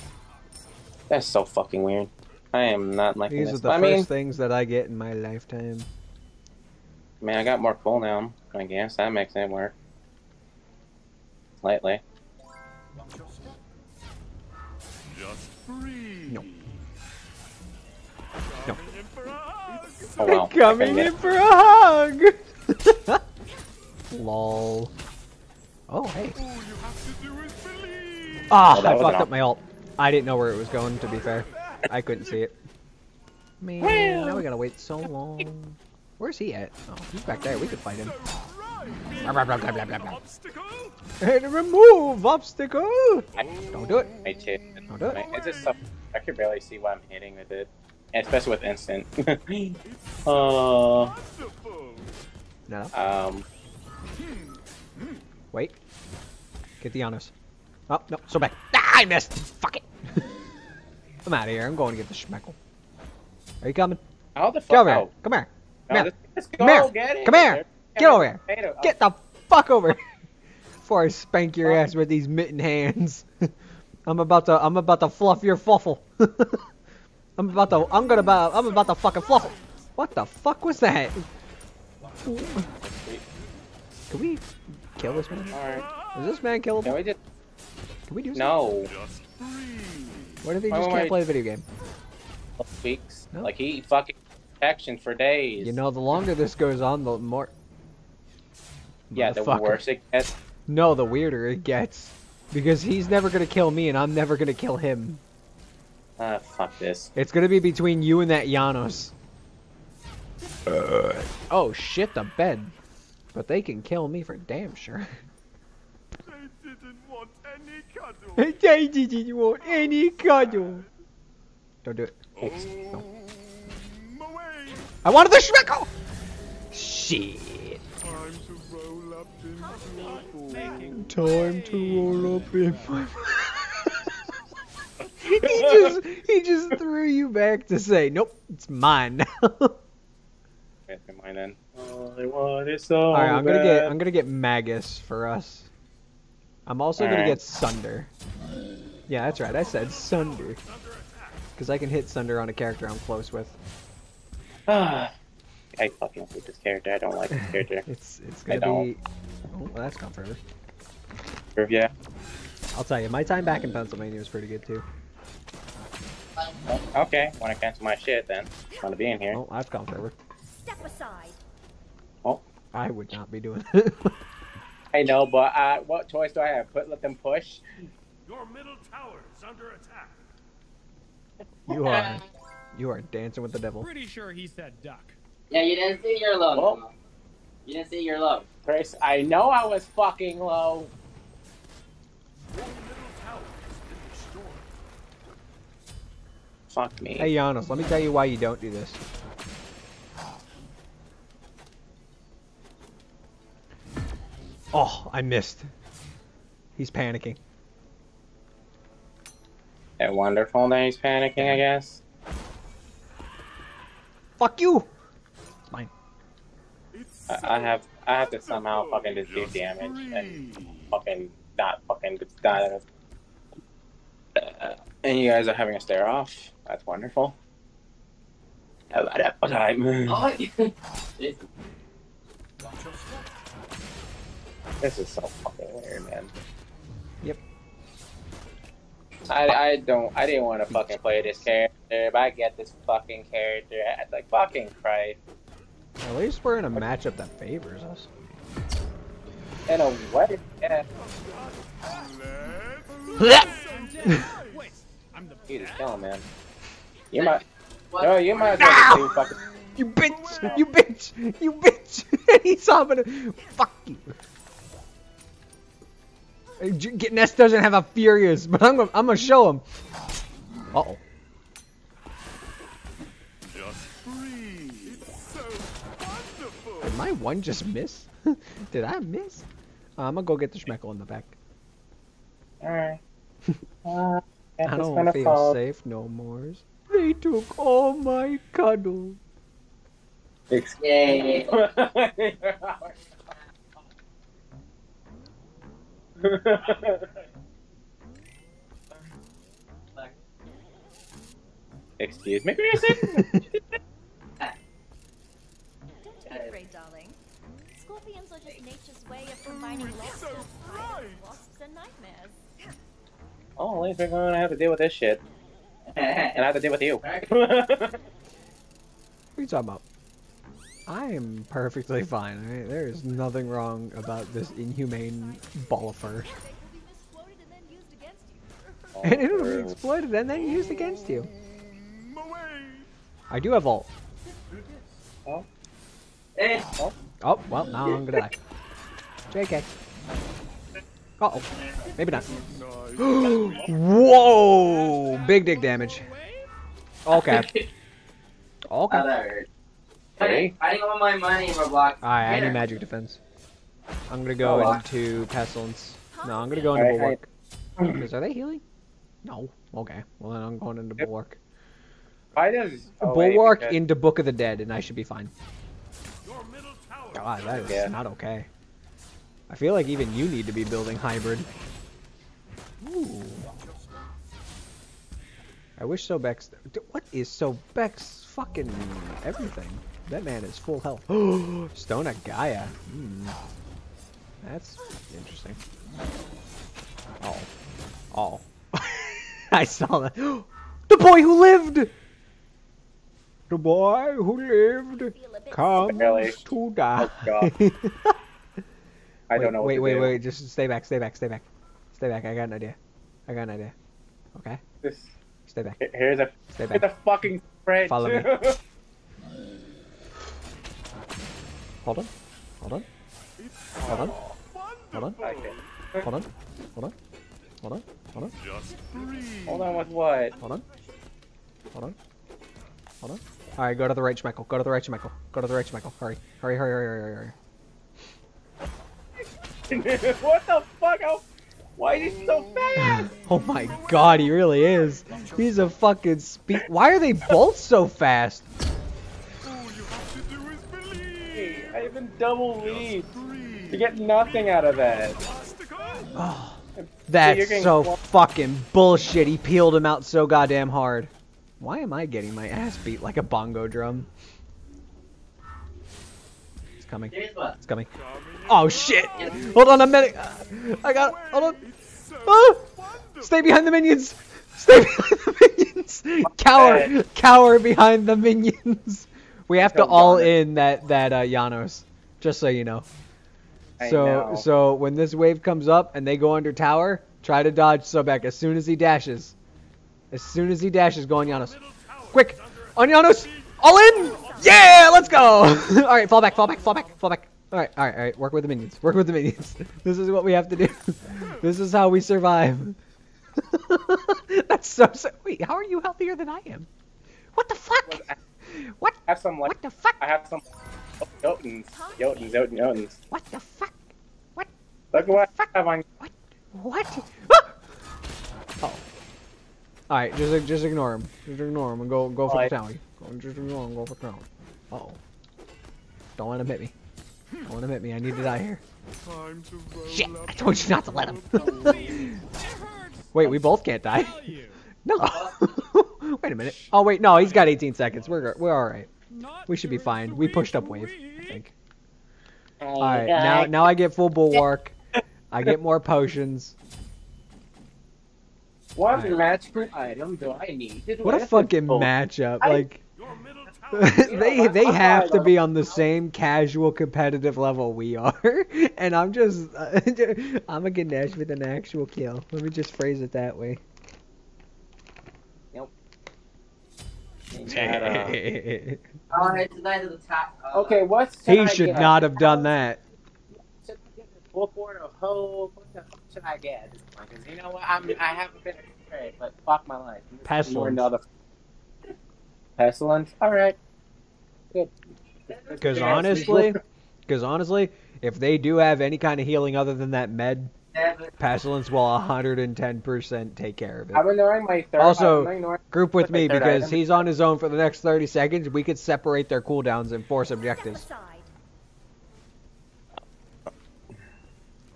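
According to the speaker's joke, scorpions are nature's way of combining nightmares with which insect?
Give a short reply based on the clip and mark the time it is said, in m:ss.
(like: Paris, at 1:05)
wasps, at 5:11.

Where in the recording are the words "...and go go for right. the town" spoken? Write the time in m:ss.
8:31.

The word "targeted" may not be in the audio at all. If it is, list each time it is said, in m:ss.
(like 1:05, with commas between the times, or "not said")
not said.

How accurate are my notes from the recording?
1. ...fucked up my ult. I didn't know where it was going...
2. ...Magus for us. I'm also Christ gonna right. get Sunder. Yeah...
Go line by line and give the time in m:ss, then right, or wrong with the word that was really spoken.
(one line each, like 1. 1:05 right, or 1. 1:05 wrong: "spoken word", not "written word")
1. 0:29 right
2. 2:24 wrong: "All", not "Christ".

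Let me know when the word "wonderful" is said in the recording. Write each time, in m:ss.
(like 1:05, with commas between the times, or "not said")
3:30, 3:46.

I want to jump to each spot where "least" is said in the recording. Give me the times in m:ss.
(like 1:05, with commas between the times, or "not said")
4:06, 5:13.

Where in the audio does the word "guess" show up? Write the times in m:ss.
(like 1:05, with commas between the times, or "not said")
0:08, 3:31.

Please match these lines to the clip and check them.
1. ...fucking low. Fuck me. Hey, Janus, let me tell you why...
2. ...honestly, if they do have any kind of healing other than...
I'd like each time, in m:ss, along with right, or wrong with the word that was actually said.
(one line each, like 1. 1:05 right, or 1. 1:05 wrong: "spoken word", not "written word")
1. 3:09 right
2. 9:37 right.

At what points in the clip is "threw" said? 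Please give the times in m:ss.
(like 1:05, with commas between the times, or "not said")
2:16.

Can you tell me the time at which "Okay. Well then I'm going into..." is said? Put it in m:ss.
5:59.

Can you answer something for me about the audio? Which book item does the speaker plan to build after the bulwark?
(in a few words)
Book of the Dead.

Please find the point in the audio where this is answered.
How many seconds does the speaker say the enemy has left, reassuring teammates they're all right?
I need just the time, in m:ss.
8:47.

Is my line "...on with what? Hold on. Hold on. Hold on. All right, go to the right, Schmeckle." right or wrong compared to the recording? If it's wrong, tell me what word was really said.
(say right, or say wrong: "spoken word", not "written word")
right.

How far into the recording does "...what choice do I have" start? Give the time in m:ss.
2:55.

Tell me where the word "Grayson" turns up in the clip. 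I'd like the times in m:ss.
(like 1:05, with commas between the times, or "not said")
5:02.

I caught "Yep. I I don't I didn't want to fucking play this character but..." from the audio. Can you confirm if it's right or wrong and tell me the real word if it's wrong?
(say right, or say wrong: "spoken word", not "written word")
right.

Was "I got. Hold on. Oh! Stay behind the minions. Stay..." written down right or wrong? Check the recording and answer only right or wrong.
right.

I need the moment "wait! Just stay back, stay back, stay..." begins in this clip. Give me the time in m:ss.
6:40.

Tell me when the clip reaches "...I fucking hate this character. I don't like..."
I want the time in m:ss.
2:34.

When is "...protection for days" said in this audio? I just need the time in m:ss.
1:34.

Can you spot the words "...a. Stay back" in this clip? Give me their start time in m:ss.
6:46.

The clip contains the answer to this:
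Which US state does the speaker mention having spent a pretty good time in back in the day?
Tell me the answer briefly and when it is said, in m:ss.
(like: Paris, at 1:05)
Pennsylvania, at 2:43.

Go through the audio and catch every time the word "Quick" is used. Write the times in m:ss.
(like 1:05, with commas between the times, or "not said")
8:02.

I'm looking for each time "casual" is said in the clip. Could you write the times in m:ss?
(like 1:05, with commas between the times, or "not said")
9:06.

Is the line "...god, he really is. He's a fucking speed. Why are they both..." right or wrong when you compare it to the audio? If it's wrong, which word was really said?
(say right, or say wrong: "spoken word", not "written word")
right.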